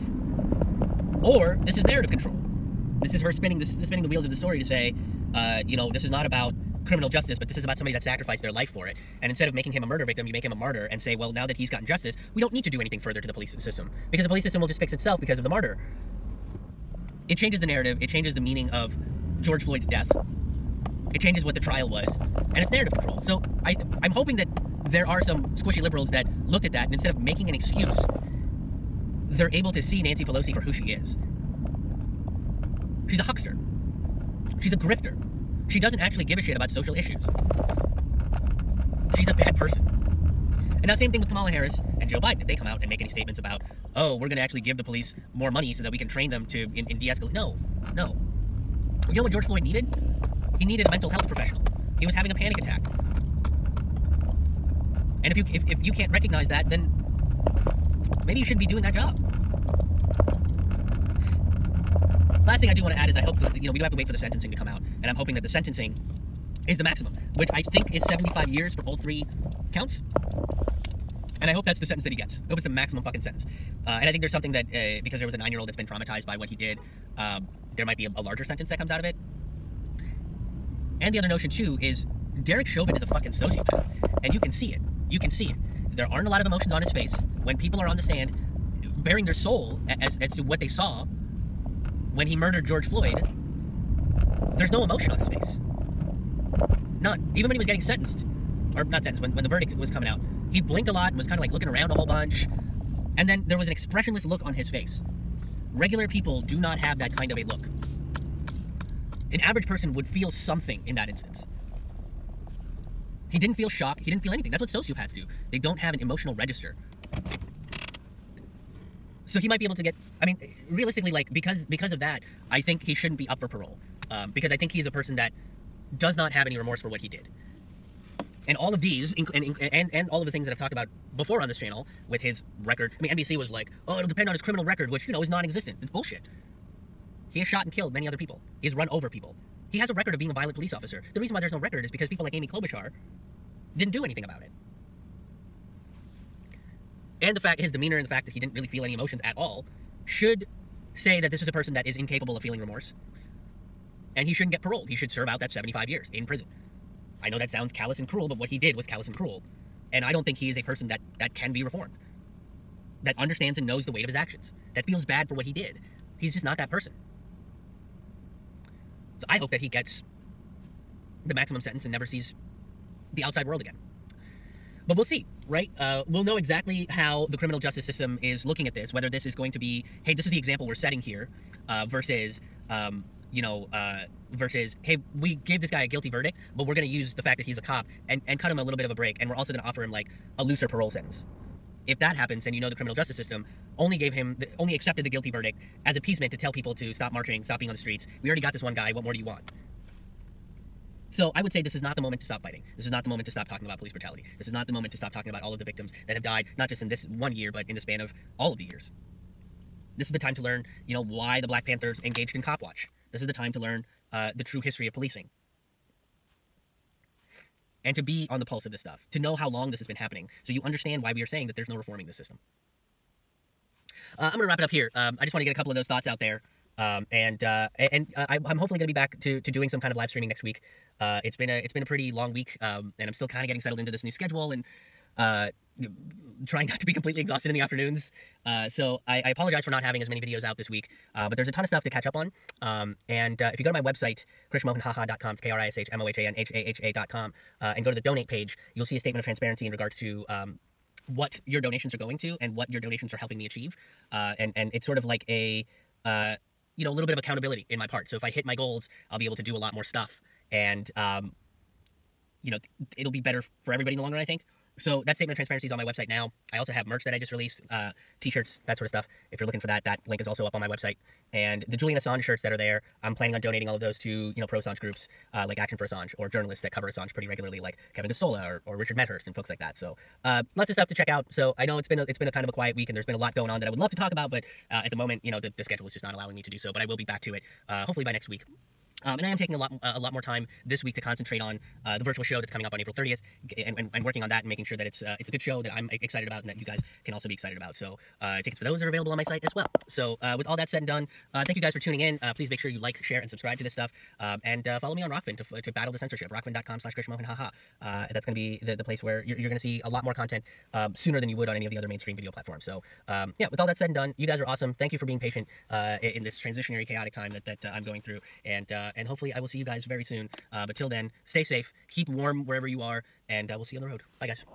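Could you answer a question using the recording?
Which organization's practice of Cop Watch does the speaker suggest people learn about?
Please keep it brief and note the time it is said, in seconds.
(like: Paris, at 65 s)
Black Panthers, at 211 s.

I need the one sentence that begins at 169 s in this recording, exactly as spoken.
So I hope that he gets the maximum sentence and never sees the outside world again.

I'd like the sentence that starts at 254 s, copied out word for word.
Uh, and and it's sort of like a uh, you know a little bit of accountability in my part.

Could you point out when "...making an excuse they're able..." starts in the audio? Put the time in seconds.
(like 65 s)
27 s.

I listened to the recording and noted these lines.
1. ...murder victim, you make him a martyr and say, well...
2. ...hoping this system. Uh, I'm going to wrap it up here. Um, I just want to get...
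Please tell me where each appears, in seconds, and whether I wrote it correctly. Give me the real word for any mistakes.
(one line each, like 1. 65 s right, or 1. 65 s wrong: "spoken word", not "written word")
1. 9 s right
2. 221 s wrong: "reforming", not "hoping".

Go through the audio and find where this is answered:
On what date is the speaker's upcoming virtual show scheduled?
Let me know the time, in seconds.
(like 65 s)
292 s.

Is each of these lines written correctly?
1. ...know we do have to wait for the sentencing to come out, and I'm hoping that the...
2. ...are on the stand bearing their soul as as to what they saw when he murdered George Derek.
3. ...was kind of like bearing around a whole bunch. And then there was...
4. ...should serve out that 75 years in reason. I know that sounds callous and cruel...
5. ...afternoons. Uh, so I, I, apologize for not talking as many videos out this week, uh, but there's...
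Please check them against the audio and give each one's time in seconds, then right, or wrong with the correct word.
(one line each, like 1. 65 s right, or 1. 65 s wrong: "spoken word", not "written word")
1. 63 s right
2. 87 s wrong: "Floyd", not "Derek"
3. 101 s wrong: "looking", not "bearing"
4. 154 s wrong: "prison", not "reason"
5. 237 s wrong: "having", not "talking".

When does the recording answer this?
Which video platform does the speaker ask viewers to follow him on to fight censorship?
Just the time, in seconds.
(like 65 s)
305 s.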